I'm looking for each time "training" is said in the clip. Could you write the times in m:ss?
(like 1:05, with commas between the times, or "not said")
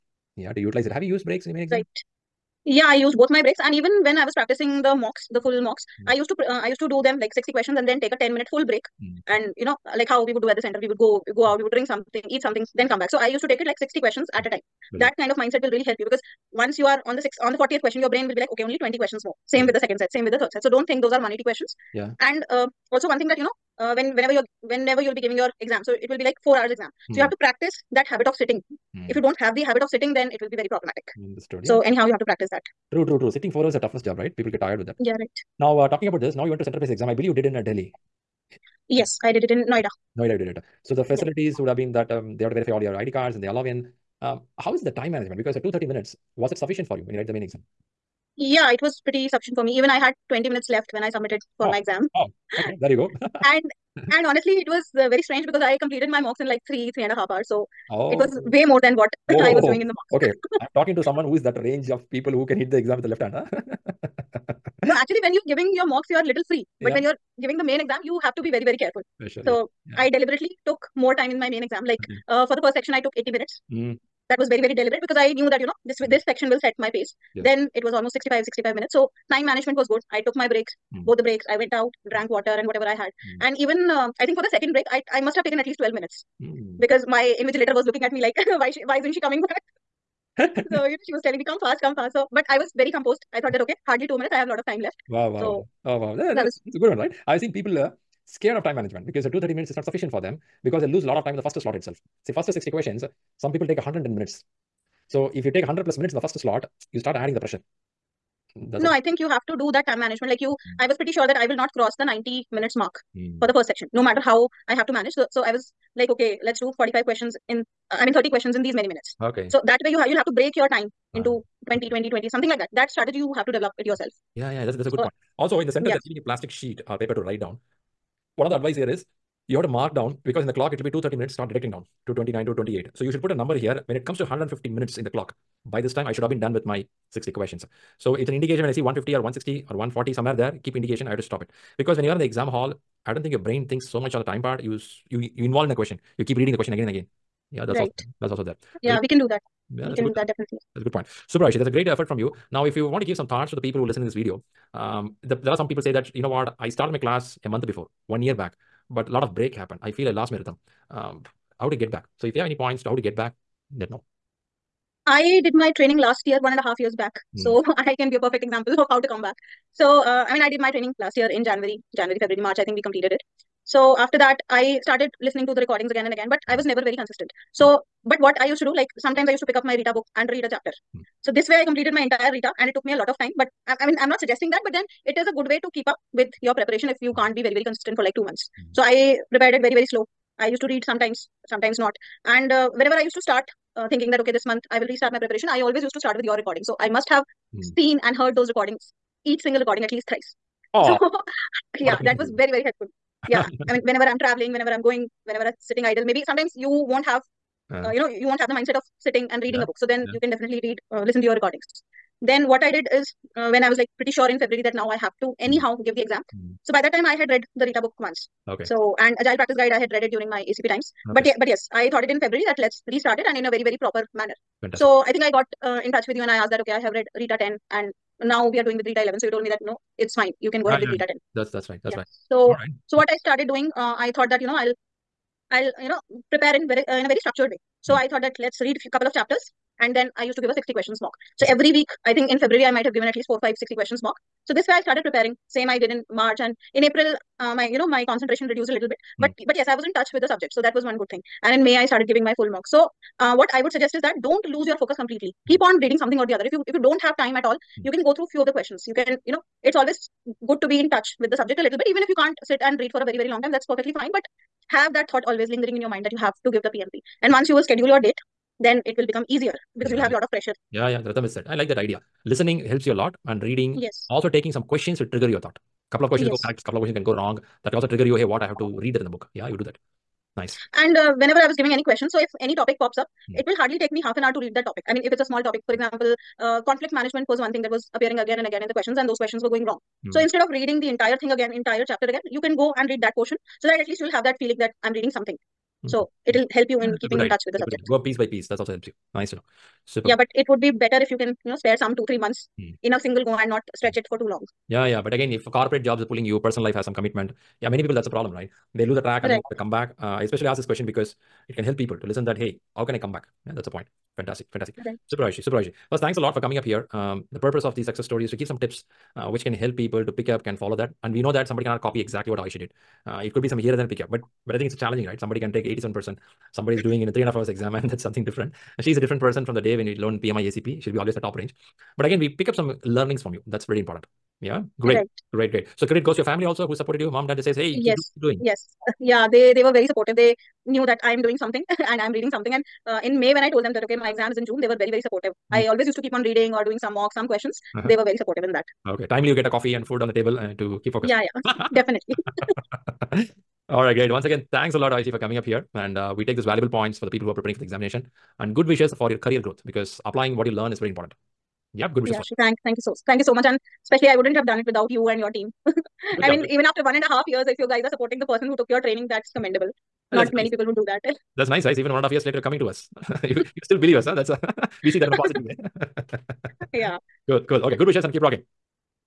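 2:45, 2:50, 6:08.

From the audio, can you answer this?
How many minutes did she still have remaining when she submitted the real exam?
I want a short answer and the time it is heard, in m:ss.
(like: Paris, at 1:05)
20 minutes, at 0:50.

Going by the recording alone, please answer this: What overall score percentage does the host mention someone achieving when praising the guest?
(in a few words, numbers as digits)
87%.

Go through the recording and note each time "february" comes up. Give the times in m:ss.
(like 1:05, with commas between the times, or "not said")
2:52, 3:34, 3:42, 4:02.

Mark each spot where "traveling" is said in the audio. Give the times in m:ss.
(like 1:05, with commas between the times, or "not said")
3:24.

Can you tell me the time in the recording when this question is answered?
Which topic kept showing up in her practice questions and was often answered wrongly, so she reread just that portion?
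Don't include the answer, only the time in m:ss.
4:46.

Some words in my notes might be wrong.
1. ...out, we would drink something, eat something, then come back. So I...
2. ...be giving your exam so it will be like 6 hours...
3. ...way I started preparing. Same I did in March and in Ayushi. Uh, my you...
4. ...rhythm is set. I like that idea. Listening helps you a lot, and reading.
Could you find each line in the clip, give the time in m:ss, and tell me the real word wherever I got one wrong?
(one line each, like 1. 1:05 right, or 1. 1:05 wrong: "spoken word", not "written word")
1. 0:11 right
2. 0:25 wrong: "4", not "6"
3. 4:04 wrong: "April", not "Ayushi"
4. 4:31 right.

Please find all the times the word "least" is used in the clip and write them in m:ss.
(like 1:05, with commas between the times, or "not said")
1:25, 3:19, 4:03, 4:53.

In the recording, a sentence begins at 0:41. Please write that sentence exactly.
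would have been that um, they have to verify all your ID cards and they allow in.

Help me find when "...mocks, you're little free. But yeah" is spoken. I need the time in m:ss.
1:05.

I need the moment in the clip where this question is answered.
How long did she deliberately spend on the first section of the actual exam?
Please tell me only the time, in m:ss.
1:13.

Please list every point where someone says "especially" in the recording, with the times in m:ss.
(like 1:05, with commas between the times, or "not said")
5:10, 6:03.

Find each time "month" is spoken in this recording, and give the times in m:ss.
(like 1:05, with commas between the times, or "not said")
2:37, 3:08, 3:14, 5:02.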